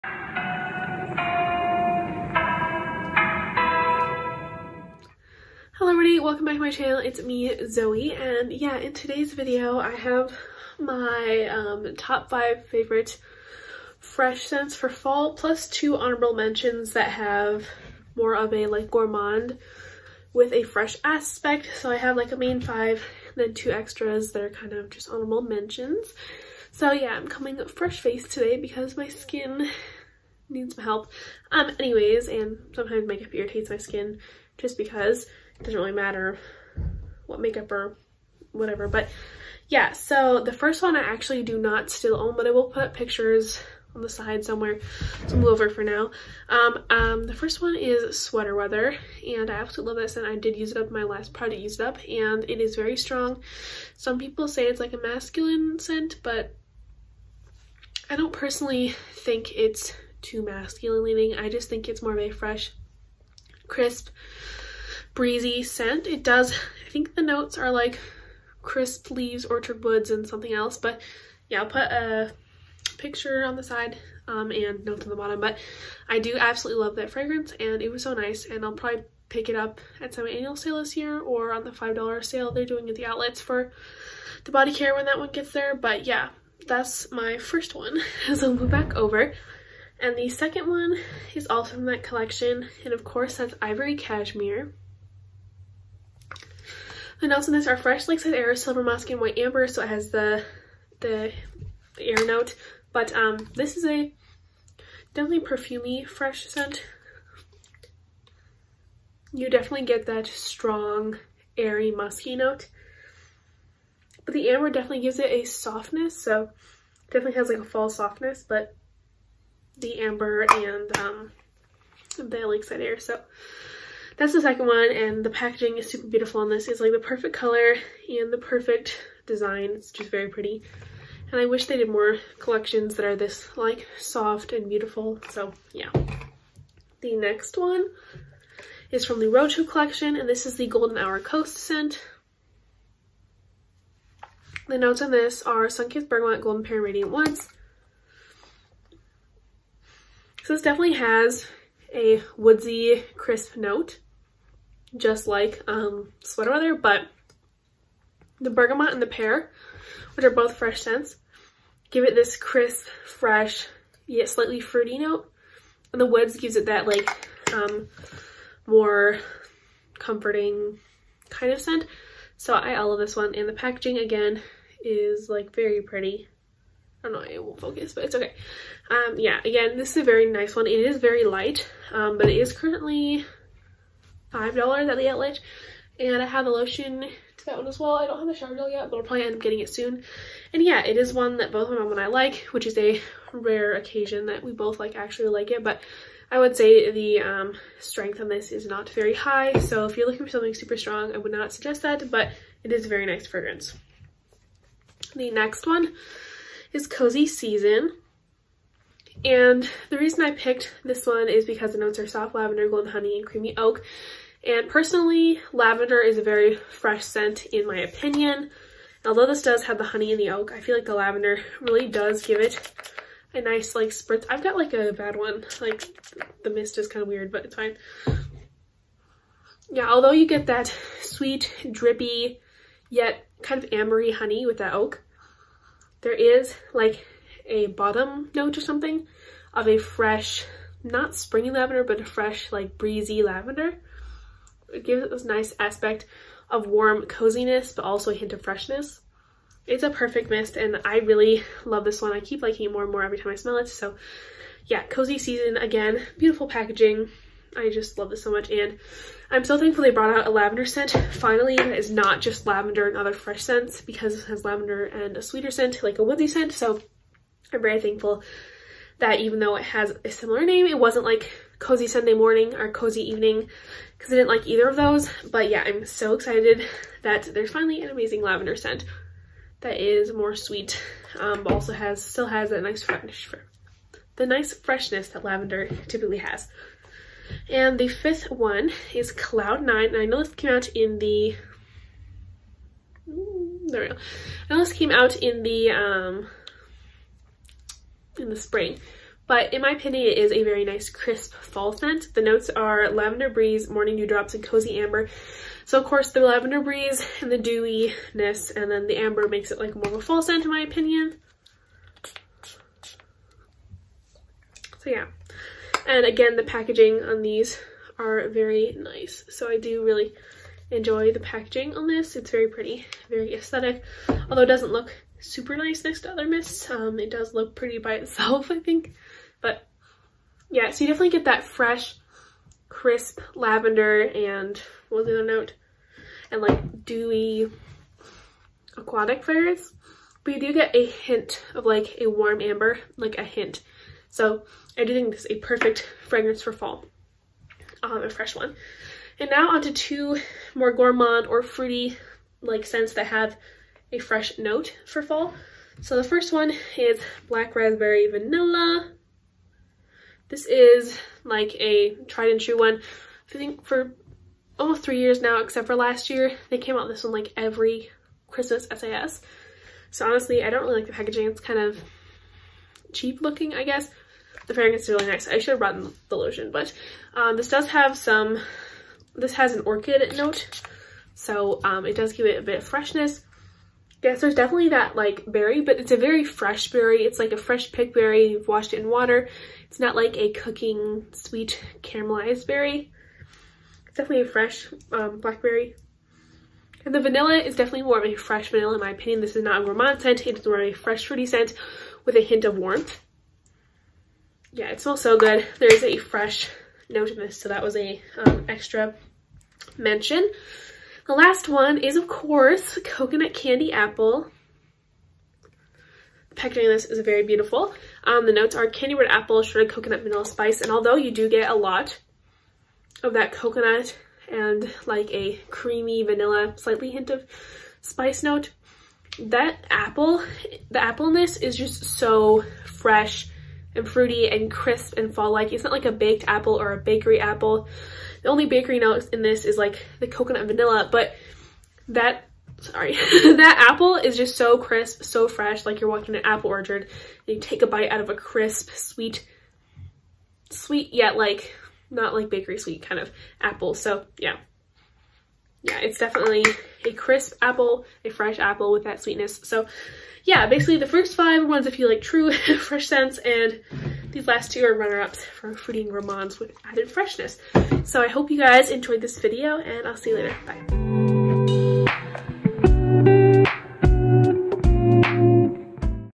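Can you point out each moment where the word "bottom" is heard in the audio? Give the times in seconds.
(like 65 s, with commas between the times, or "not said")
75 s, 237 s.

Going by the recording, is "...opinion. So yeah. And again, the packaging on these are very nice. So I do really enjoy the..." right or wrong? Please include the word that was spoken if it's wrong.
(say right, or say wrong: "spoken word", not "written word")
right.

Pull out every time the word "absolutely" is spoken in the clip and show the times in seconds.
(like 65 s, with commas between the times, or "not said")
49 s, 76 s.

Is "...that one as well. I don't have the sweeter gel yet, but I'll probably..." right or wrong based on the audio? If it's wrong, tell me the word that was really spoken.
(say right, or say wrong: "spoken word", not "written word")
wrong: "shower", not "sweeter".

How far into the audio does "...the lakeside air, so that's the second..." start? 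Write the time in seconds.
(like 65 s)
122 s.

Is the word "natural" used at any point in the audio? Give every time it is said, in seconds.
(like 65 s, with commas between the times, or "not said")
not said.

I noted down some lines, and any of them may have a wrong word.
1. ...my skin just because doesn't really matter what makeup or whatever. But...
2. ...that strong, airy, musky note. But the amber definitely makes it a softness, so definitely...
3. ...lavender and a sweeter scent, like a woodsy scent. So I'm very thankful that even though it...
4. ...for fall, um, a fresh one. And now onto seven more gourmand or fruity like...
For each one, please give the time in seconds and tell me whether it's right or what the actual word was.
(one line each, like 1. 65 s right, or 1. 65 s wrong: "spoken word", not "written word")
1. 33 s right
2. 110 s wrong: "gives", not "makes"
3. 264 s right
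4. 346 s wrong: "two", not "seven".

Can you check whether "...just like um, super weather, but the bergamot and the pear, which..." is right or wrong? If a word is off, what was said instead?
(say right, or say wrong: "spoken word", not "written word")
wrong: "sweater", not "super".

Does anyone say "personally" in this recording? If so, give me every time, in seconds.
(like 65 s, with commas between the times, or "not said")
58 s, 214 s.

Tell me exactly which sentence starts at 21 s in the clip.
So I have like a main 5, then two extras that are kind of just honorable mentions.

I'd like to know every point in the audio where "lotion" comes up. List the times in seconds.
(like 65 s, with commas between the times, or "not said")
186 s, 376 s.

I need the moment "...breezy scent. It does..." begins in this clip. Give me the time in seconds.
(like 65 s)
65 s.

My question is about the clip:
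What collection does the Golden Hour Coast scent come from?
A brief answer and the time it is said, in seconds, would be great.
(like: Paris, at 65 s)
Roadshow, at 139 s.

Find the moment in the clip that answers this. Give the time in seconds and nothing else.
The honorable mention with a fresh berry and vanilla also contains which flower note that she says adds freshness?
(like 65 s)
379 s.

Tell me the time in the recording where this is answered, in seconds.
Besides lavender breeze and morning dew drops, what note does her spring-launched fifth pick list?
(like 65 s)
304 s.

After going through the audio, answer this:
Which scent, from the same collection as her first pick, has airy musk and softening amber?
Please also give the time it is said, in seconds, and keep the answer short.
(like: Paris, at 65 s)
Ivory Cashmere, at 93 s.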